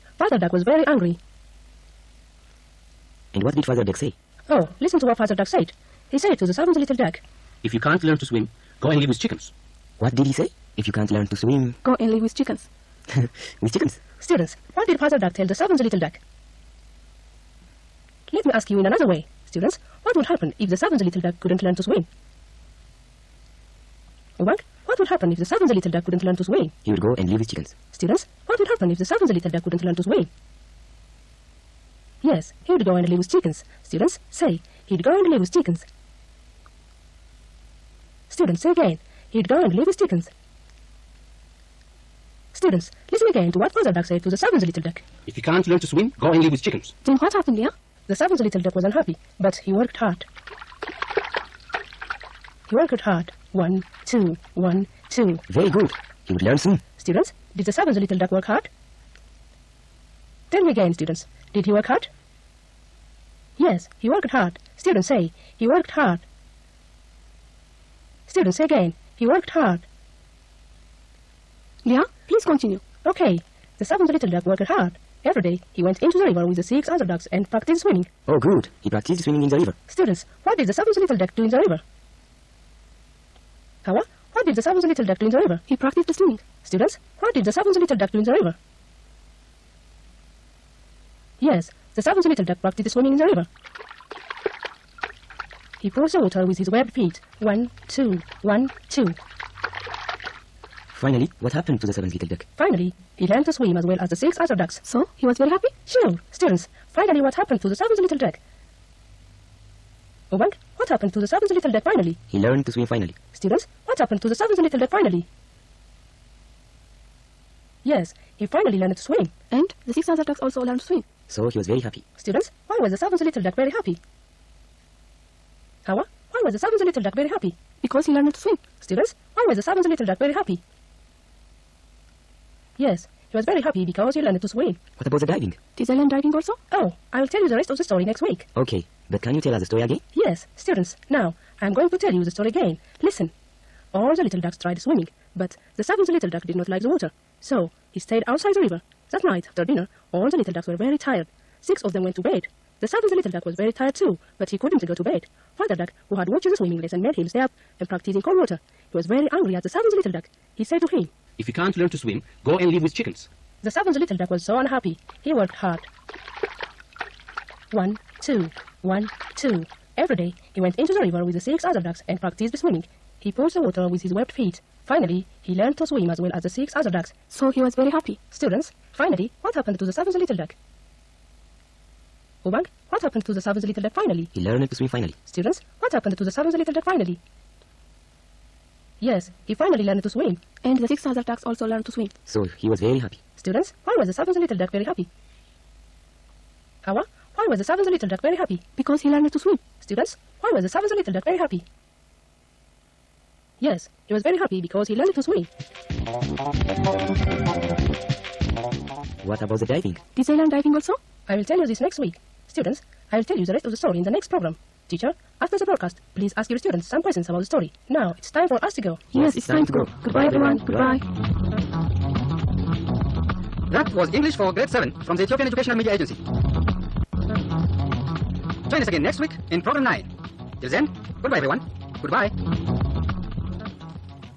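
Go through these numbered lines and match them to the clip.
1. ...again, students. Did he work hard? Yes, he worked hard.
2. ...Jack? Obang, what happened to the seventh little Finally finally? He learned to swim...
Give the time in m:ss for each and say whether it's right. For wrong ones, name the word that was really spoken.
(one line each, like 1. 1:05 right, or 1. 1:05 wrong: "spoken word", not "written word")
1. 1:00 right
2. 1:48 wrong: "Jack", not "Finally".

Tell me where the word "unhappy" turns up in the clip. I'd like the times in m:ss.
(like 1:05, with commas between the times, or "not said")
0:48, 2:44.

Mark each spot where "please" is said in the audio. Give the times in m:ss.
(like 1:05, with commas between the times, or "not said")
1:12, 3:36.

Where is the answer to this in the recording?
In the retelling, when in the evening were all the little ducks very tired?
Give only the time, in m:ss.
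2:29.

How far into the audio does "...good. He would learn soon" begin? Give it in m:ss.
0:55.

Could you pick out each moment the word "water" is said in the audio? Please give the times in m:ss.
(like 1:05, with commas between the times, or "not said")
1:36, 2:26, 2:38, 2:53.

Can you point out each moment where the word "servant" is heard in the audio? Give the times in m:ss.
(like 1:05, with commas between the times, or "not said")
0:06, 0:15, 0:48, 0:57.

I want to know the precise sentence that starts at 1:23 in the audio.
Hawa, what did the seventh little duck do in the river?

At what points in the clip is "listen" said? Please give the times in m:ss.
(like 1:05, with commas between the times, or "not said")
0:04, 0:43, 2:23.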